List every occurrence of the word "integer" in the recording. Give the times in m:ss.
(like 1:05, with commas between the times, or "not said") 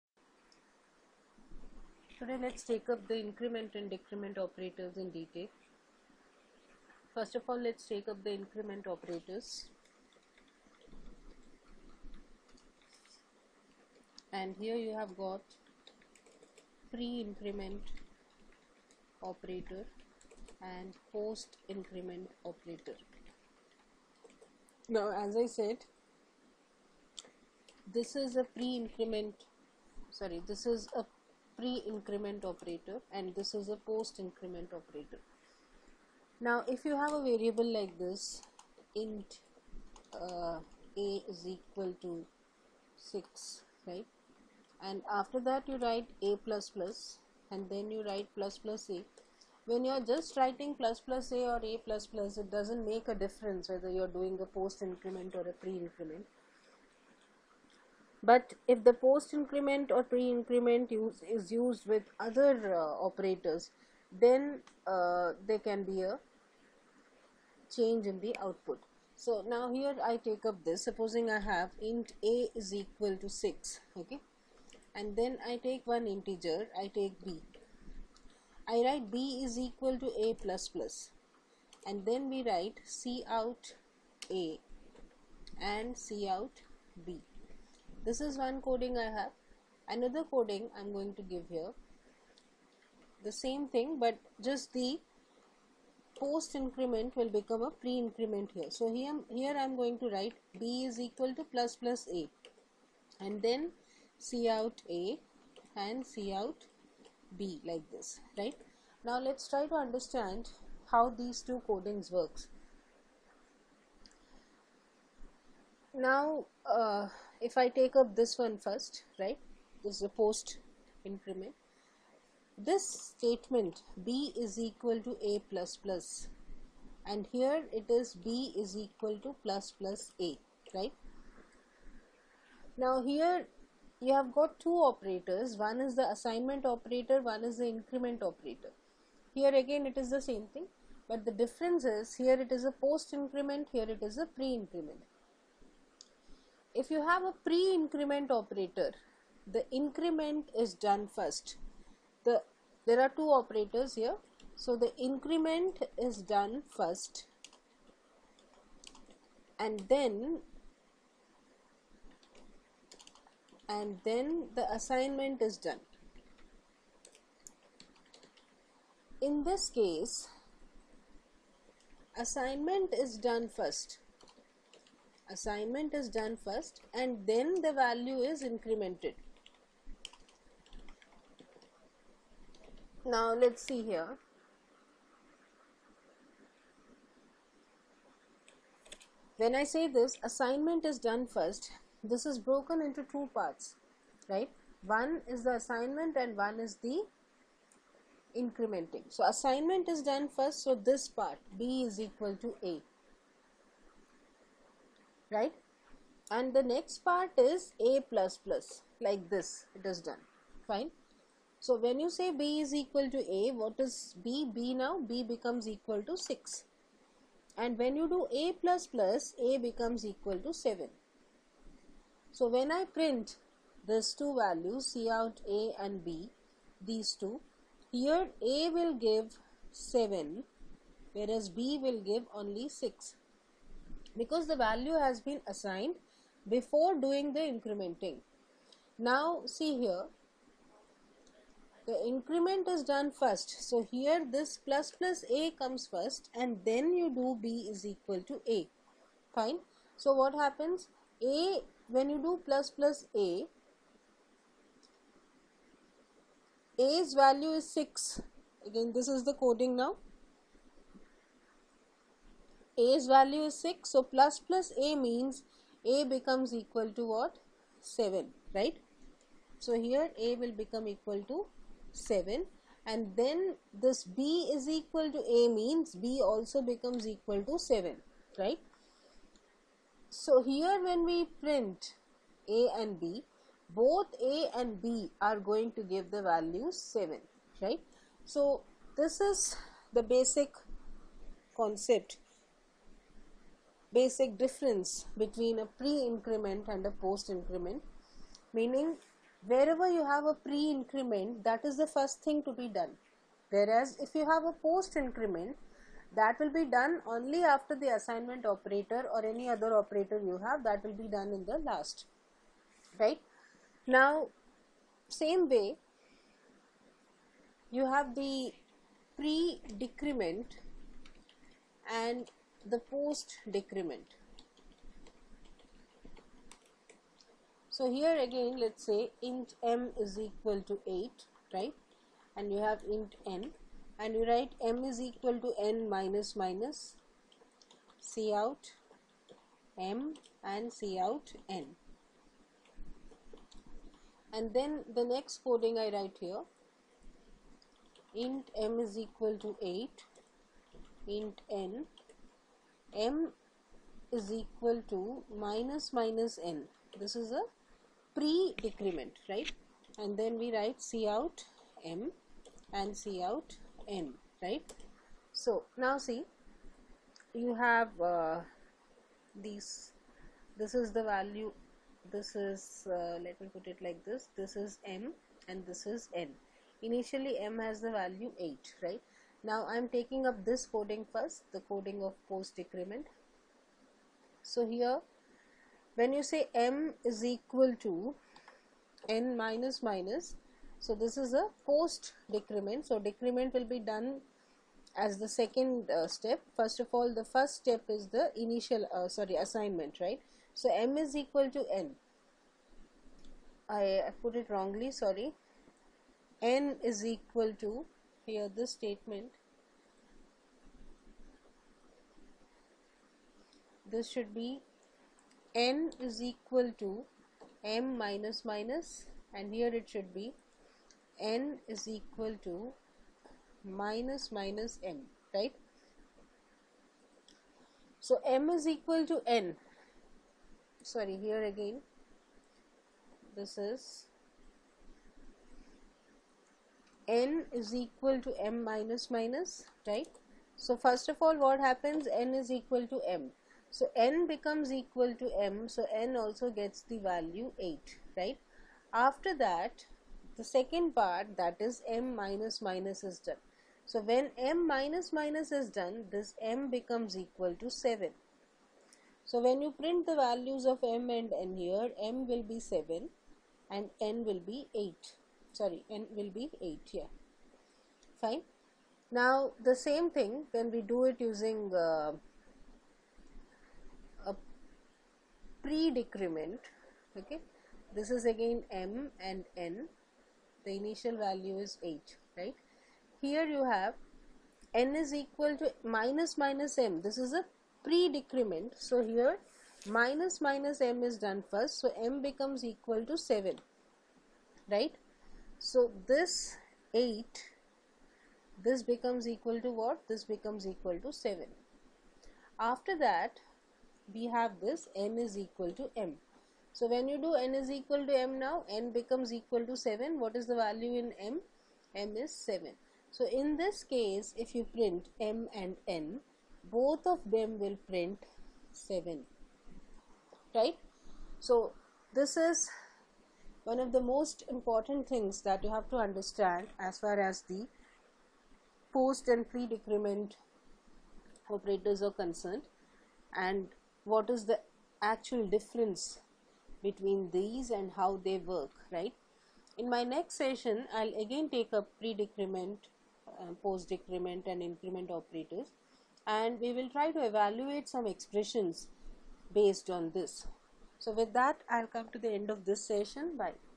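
1:16.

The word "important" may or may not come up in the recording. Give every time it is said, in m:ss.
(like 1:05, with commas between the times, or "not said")
8:44.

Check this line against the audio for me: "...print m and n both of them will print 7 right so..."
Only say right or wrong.
right.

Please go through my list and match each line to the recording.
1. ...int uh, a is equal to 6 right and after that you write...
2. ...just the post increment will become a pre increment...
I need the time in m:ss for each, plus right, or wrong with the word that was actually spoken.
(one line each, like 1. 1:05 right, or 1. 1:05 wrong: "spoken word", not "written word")
1. 0:38 right
2. 1:34 right.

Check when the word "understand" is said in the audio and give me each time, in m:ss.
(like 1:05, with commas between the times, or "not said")
1:49, 8:45.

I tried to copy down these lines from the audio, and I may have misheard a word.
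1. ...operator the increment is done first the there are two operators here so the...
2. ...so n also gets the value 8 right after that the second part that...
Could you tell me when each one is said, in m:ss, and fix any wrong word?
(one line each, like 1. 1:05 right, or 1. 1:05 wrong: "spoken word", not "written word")
1. 2:28 right
2. 7:25 right.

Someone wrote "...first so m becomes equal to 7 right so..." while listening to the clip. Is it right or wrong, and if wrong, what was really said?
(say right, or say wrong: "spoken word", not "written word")
right.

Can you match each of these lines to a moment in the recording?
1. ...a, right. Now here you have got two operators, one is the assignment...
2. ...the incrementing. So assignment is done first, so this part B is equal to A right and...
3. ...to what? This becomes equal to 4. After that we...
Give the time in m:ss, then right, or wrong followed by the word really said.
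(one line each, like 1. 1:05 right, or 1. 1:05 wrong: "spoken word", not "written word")
1. 2:10 right
2. 3:16 right
3. 8:19 wrong: "7", not "4".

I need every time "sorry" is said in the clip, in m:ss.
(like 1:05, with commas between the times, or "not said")
0:30, 6:39, 6:44, 7:10, 7:45.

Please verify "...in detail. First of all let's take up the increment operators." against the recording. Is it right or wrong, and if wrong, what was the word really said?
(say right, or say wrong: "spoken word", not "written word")
right.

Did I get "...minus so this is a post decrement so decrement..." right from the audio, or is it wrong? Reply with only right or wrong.
right.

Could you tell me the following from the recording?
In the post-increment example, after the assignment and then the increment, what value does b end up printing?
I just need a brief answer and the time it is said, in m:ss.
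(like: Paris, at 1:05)
6, at 3:51.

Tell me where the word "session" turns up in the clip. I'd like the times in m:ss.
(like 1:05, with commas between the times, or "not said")
9:00, 9:12.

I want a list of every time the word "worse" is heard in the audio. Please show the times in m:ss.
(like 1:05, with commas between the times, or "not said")
not said.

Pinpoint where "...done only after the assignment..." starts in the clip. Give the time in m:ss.
5:06.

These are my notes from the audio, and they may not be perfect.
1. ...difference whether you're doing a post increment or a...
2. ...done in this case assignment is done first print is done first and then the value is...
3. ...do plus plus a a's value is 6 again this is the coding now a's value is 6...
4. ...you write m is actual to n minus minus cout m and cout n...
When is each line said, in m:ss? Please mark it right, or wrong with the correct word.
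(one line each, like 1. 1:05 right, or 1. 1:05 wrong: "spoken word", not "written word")
1. 0:53 right
2. 2:45 wrong: "assignment", not "print"
3. 4:12 right
4. 5:34 wrong: "equal", not "actual".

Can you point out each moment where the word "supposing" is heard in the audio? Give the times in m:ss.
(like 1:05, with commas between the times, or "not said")
1:10.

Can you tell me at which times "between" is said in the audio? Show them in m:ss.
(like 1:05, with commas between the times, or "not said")
4:55, 8:56.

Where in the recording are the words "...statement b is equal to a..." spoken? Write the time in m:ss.
2:02.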